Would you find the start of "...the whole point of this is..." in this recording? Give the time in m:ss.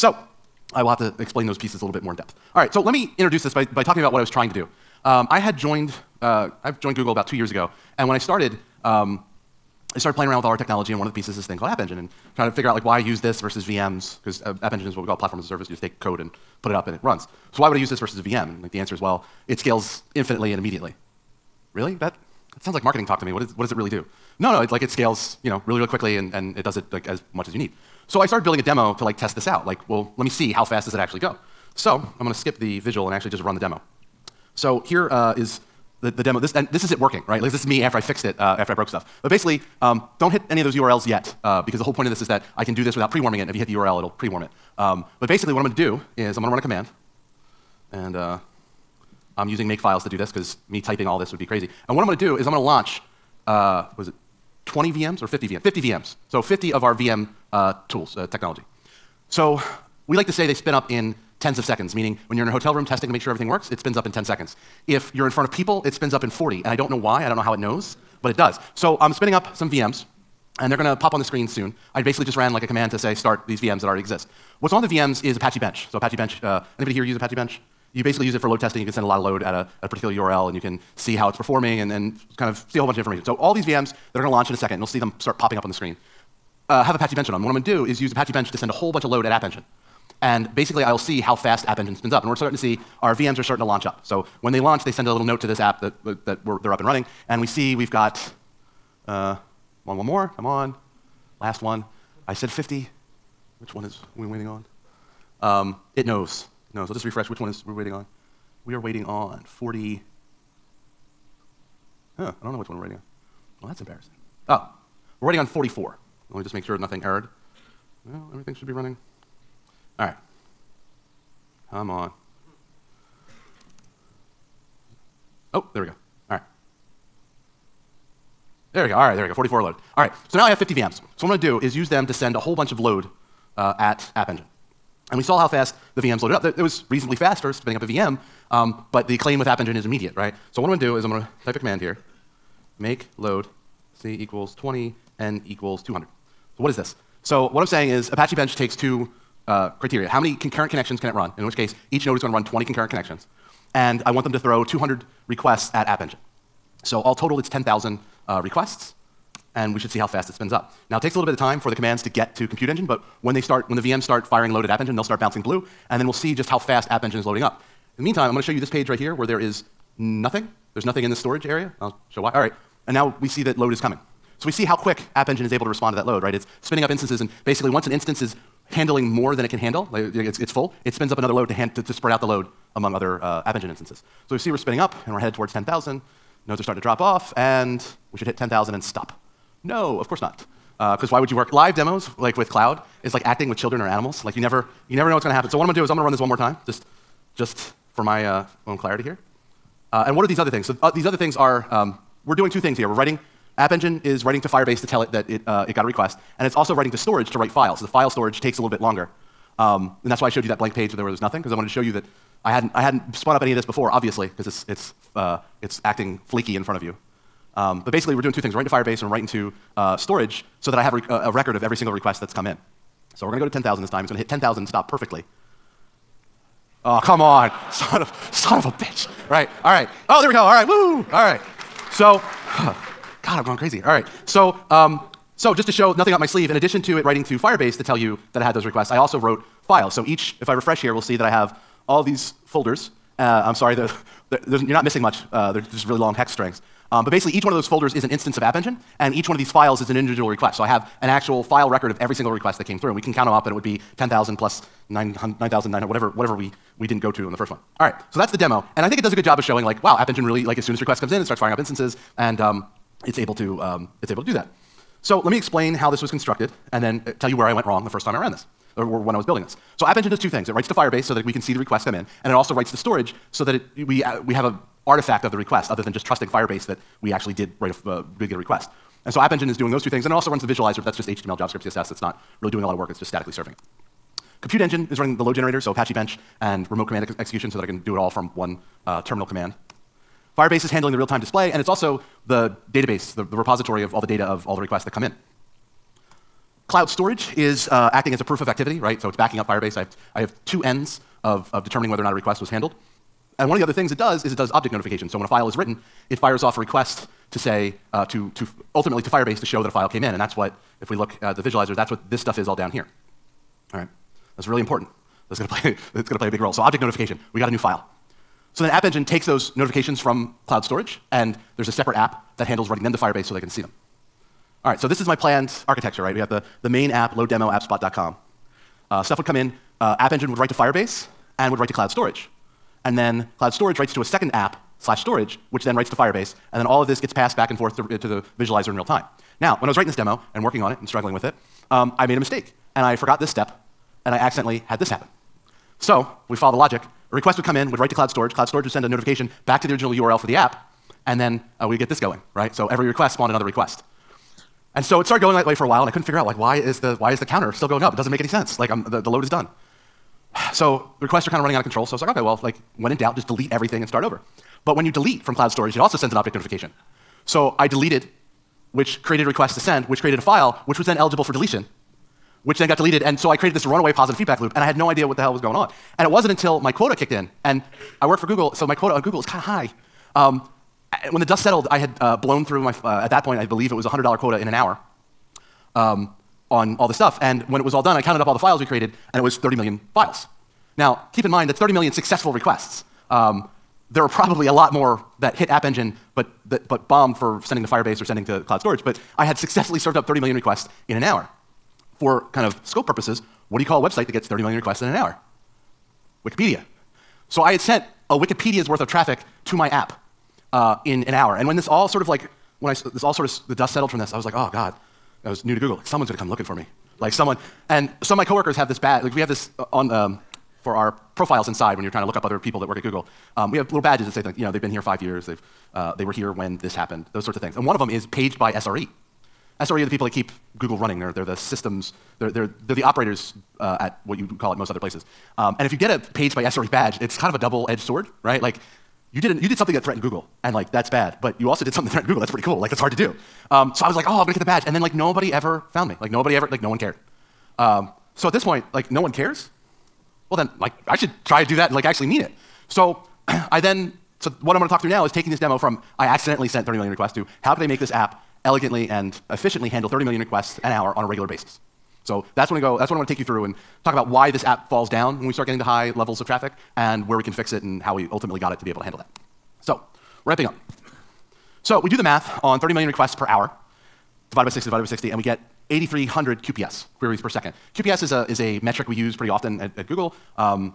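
0:41.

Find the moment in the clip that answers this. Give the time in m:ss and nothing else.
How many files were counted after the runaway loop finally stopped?
6:29.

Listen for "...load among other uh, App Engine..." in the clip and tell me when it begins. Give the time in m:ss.
3:02.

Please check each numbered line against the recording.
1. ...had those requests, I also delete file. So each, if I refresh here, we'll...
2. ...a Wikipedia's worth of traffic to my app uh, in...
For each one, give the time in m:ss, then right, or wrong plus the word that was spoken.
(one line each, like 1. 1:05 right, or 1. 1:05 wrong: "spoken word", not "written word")
1. 3:58 wrong: "wrote", not "delete"
2. 6:48 right.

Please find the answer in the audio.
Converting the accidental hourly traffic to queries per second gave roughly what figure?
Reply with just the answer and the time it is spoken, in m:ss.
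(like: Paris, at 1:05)
8,300, at 7:55.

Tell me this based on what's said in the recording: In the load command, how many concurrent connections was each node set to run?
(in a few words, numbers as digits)
20.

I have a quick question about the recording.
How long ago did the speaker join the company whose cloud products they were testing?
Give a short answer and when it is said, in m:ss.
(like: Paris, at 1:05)
2 years, at 0:07.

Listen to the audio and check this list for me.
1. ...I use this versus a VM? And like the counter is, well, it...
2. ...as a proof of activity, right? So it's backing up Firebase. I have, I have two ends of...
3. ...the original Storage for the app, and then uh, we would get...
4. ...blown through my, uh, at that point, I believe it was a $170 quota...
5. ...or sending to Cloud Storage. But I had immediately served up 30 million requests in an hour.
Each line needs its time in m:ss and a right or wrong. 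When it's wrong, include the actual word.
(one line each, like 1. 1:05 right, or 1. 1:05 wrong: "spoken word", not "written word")
1. 0:17 wrong: "answer", not "counter"
2. 4:58 right
3. 5:49 wrong: "URL", not "Storage"
4. 6:22 wrong: "100", not "170"
5. 6:37 wrong: "successfully", not "immediately".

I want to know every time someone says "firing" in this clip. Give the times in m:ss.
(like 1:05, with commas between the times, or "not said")
2:44, 4:21.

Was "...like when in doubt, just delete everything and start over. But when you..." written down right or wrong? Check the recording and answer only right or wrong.
right.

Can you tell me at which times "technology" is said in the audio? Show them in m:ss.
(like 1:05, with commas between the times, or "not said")
0:10, 0:58.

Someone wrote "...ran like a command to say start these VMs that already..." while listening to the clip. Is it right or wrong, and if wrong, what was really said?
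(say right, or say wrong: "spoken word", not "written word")
right.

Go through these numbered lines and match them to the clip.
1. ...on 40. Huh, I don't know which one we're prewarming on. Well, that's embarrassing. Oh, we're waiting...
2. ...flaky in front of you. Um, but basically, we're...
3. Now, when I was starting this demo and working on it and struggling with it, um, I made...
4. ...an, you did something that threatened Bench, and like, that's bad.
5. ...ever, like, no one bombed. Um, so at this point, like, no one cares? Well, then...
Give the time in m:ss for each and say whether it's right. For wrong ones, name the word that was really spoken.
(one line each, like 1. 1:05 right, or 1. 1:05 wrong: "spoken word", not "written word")
1. 1:49 wrong: "waiting", not "prewarming"
2. 3:36 right
3. 5:39 wrong: "writing", not "starting"
4. 7:19 wrong: "Google", not "Bench"
5. 7:26 wrong: "cared", not "bombed".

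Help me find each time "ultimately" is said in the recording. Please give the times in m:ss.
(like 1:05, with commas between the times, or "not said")
5:08, 7:48.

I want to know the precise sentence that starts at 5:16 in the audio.
So object notification, we got a new file.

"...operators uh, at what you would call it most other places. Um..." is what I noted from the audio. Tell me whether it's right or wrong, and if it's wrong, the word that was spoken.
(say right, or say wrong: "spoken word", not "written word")
right.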